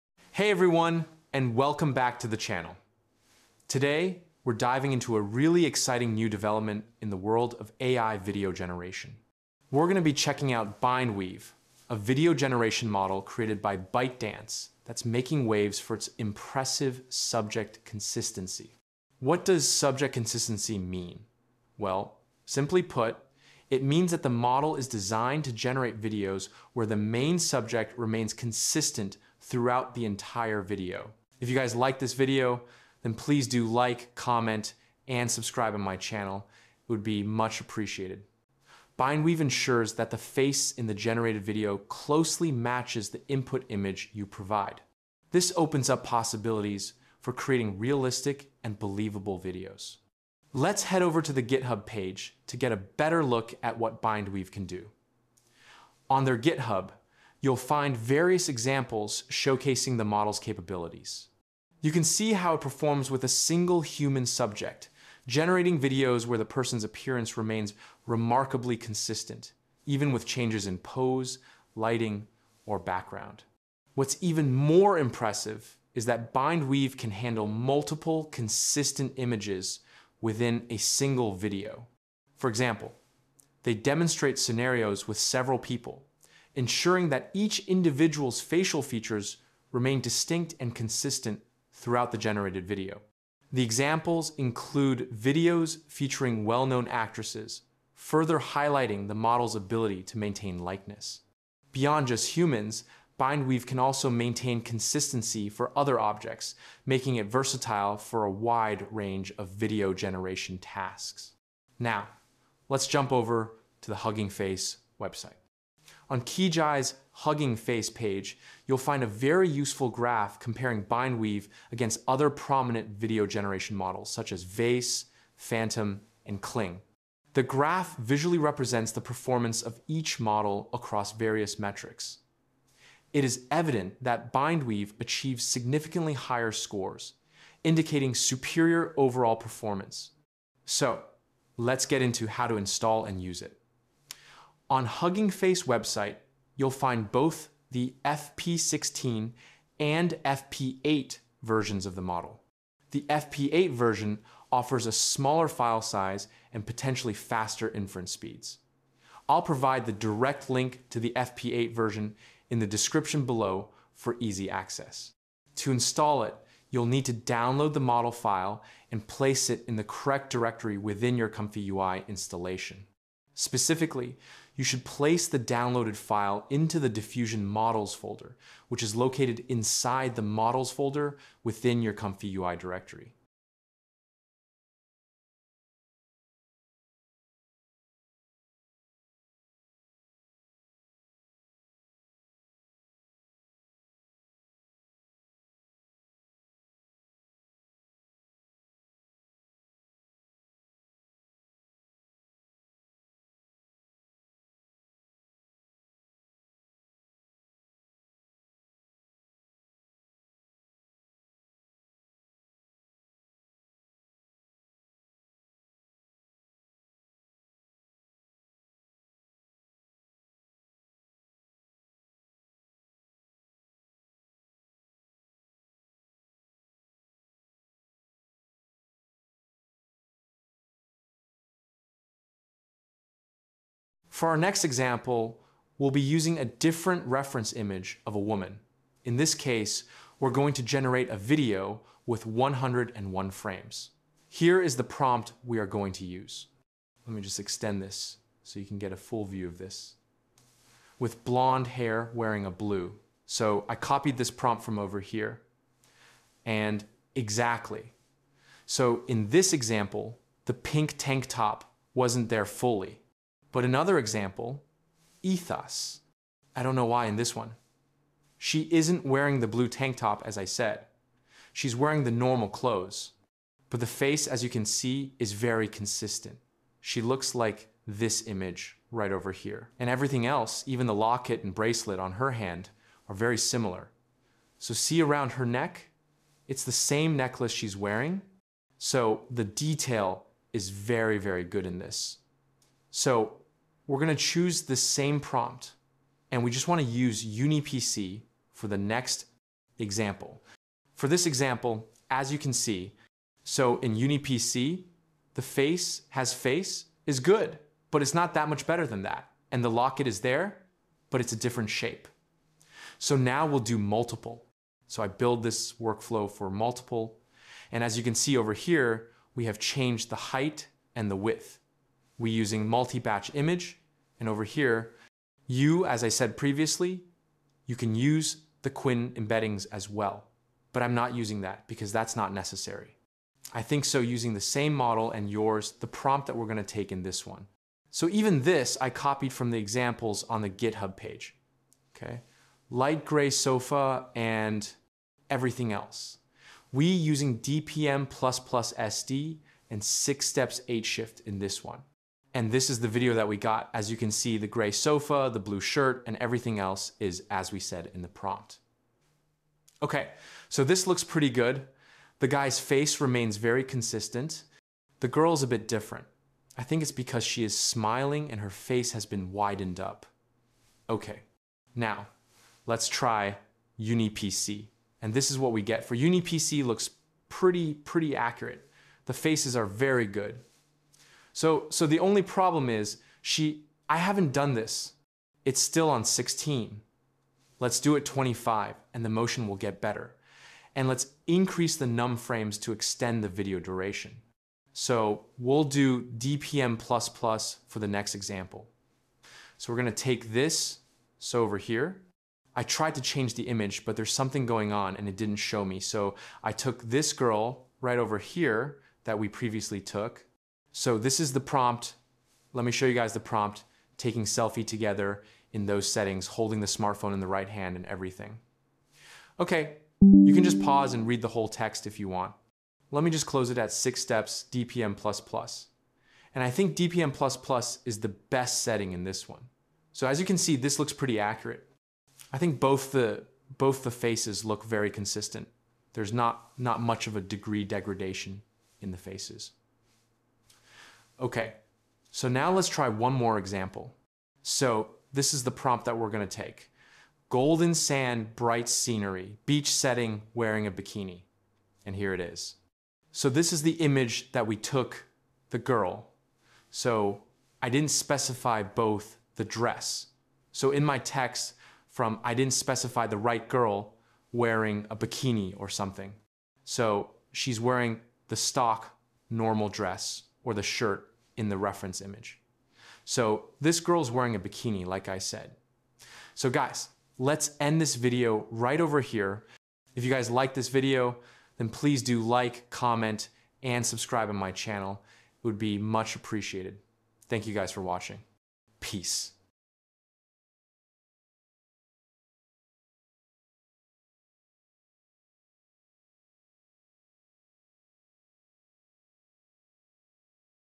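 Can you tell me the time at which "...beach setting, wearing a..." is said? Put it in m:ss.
7:29.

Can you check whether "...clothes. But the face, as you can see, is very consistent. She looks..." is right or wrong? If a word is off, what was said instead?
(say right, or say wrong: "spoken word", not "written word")
right.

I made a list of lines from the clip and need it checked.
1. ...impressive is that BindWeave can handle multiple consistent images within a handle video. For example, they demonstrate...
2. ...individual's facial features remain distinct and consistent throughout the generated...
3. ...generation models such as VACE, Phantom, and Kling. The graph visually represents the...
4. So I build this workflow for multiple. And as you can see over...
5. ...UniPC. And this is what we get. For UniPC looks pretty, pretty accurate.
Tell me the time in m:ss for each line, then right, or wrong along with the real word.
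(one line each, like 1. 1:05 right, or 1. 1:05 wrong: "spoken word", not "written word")
1. 1:14 wrong: "single", not "handle"
2. 1:27 right
3. 2:03 right
4. 5:14 right
5. 6:13 right.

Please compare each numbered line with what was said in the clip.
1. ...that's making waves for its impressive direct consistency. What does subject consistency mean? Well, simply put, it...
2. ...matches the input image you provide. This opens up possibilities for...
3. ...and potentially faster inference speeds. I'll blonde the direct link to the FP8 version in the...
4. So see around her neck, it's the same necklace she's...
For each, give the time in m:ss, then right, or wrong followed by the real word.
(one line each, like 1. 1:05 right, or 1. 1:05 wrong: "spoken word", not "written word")
1. 0:14 wrong: "subject", not "direct"
2. 0:42 right
3. 2:36 wrong: "provide", not "blonde"
4. 4:44 right.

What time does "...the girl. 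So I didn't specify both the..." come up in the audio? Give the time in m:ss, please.
7:35.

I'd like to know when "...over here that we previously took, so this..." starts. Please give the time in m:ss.
6:47.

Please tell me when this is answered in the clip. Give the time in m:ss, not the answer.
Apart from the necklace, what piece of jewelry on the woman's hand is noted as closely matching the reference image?
4:41.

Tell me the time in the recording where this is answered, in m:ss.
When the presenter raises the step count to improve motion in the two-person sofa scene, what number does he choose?
6:28.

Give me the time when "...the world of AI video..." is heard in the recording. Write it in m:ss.
0:07.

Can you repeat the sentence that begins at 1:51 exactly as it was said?
Now, let's jump over to the Hugging Face website.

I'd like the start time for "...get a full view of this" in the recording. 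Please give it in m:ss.
4:08.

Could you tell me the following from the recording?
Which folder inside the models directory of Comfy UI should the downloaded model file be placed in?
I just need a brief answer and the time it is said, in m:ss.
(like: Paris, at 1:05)
diffusion models, at 2:56.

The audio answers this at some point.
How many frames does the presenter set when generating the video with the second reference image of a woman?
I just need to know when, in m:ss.
4:02.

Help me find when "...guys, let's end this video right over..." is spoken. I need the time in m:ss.
7:56.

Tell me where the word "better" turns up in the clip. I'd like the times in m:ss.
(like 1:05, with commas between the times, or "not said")
0:52, 5:08, 6:29.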